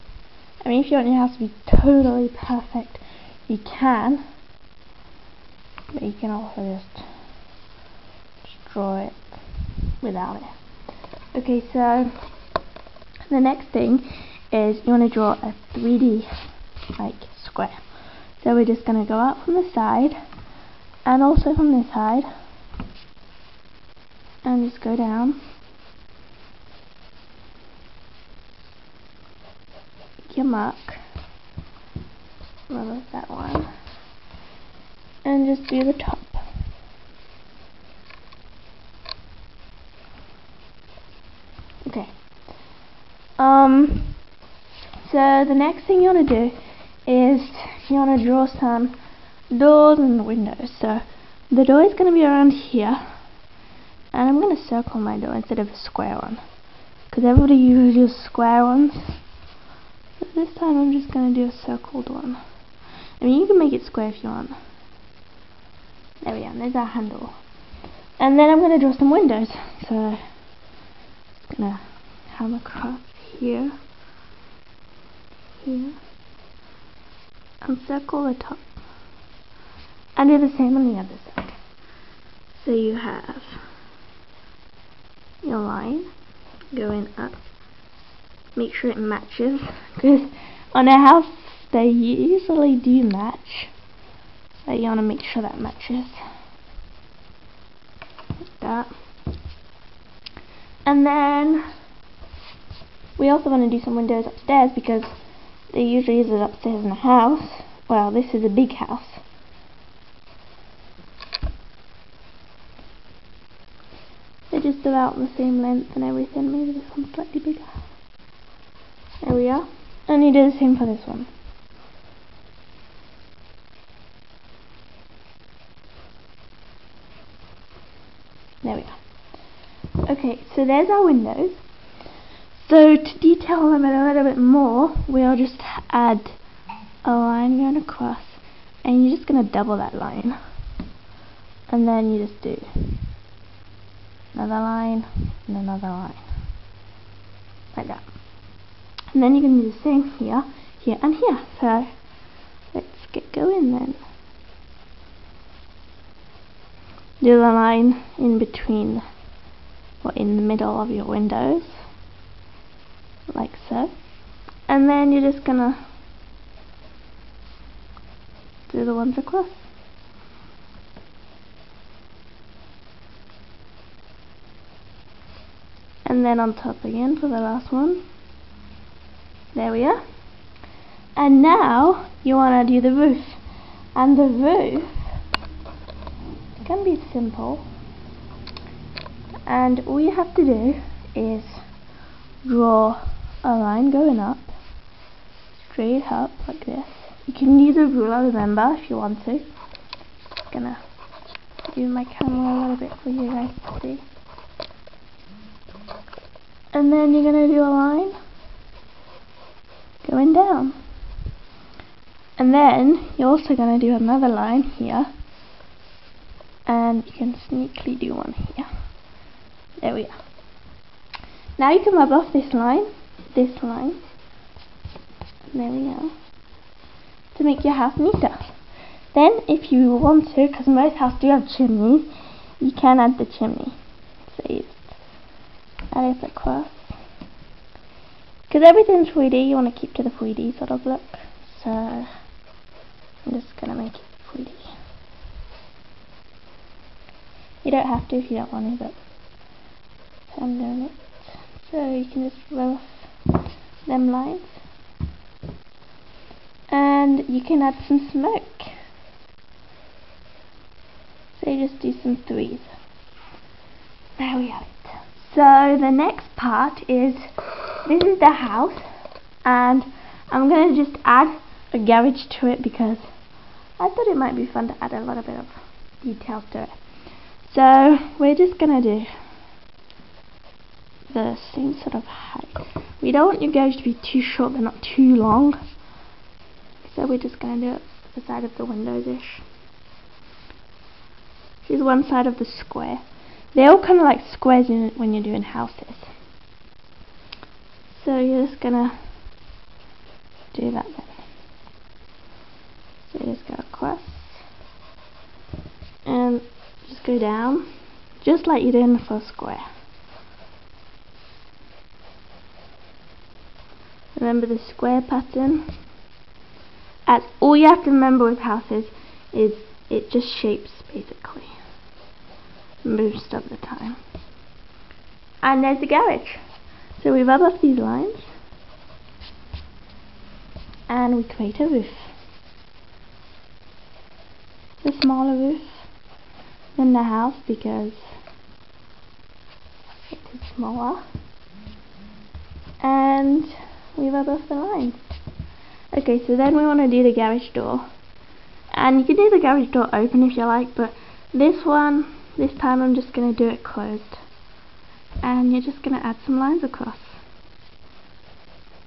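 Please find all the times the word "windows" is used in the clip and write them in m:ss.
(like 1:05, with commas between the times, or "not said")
0:50, 1:09, 1:43, 2:11, 2:41, 4:48.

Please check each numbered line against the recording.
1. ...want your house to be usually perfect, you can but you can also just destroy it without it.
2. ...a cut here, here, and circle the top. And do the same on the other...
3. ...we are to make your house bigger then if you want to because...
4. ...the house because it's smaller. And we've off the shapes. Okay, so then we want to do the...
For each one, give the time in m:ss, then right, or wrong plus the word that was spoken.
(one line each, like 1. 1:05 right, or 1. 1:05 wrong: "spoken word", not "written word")
1. 0:00 wrong: "totally", not "usually"
2. 1:12 right
3. 3:45 wrong: "neater", not "bigger"
4. 5:36 wrong: "lines", not "shapes".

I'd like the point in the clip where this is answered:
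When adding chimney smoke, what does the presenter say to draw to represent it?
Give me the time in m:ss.
4:22.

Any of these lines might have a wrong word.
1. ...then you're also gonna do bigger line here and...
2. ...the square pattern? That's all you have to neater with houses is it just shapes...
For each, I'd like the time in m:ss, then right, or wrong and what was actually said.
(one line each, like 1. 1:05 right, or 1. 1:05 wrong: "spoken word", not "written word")
1. 3:32 wrong: "another", not "bigger"
2. 5:14 wrong: "remember", not "neater".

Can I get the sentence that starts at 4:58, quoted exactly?
So you're just gonna do that then.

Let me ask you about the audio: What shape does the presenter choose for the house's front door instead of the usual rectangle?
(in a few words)
Circled.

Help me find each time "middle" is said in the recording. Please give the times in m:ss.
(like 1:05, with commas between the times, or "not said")
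2:40.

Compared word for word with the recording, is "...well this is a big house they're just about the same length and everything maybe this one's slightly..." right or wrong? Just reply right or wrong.
right.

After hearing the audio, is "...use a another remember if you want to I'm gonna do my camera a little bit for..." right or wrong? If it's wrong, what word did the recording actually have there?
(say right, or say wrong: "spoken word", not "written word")
wrong: "ruler", not "another".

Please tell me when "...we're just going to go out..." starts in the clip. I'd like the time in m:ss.
0:18.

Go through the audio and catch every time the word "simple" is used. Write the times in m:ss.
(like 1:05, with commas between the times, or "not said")
3:07.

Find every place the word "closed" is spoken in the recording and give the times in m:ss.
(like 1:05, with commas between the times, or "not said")
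5:53.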